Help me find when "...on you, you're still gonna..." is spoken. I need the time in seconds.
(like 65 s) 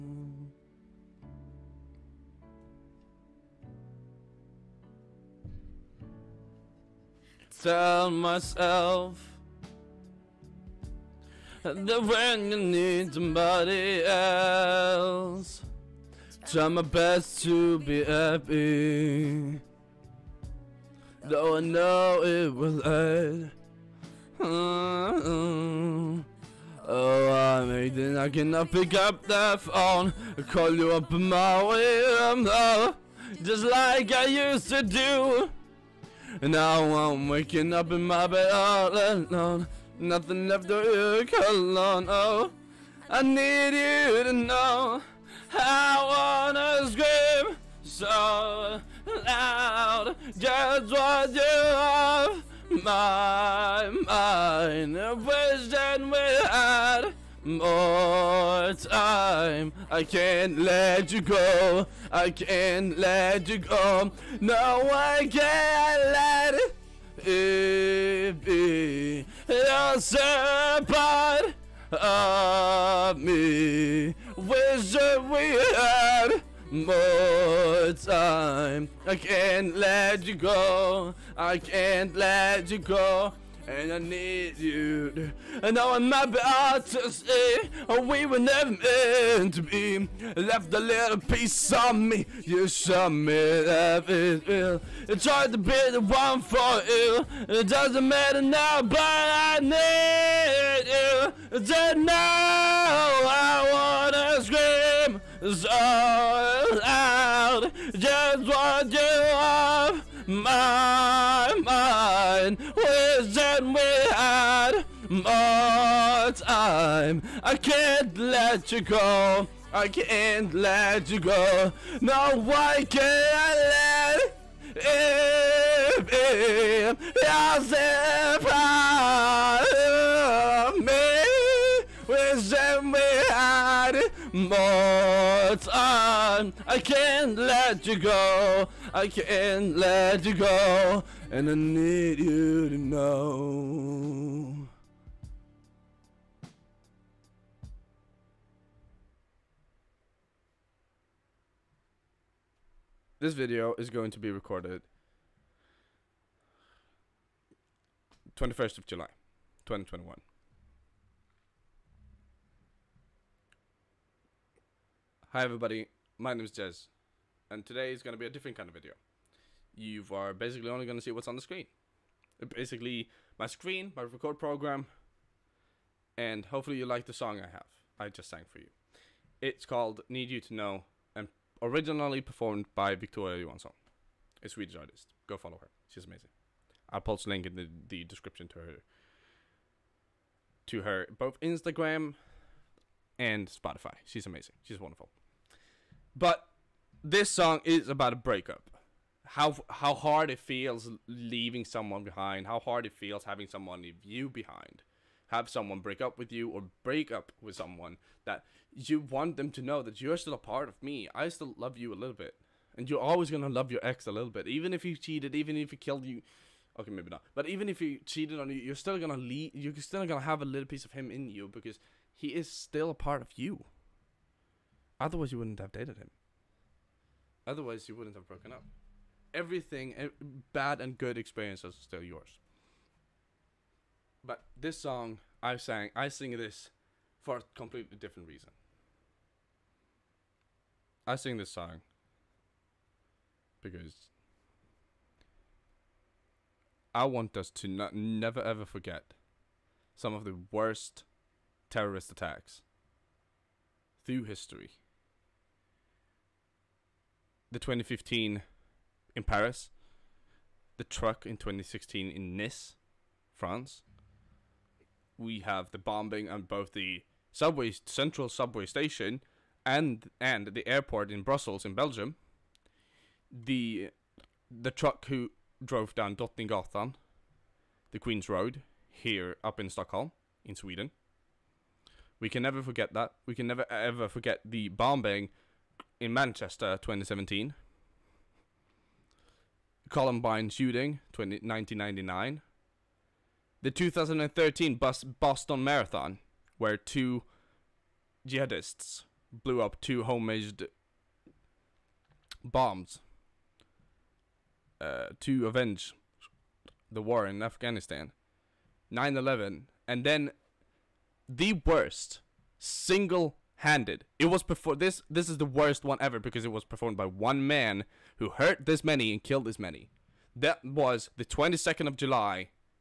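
218 s.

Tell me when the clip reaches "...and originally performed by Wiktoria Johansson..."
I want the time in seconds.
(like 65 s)
181 s.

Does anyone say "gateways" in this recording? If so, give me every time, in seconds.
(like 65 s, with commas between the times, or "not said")
not said.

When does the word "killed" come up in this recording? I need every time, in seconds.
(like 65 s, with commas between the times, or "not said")
215 s, 319 s.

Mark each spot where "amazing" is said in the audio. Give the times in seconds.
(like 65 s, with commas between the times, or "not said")
186 s, 194 s.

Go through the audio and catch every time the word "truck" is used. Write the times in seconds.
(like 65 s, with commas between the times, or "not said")
260 s, 274 s.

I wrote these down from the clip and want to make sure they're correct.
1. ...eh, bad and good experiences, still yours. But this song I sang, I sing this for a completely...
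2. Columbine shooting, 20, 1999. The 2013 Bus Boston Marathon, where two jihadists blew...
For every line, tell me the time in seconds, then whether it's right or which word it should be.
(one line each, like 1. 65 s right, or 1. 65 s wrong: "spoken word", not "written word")
1. 229 s right
2. 289 s right.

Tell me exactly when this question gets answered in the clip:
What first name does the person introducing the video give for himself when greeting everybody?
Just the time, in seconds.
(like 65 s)
166 s.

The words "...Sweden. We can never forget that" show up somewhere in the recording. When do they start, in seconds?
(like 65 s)
280 s.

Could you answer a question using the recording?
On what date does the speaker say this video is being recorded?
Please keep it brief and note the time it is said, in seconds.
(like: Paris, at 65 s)
21 July 2021, at 158 s.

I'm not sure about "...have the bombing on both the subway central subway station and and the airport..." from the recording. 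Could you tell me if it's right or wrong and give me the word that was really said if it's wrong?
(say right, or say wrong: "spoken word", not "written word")
right.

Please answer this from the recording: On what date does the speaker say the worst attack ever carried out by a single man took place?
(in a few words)
22 July.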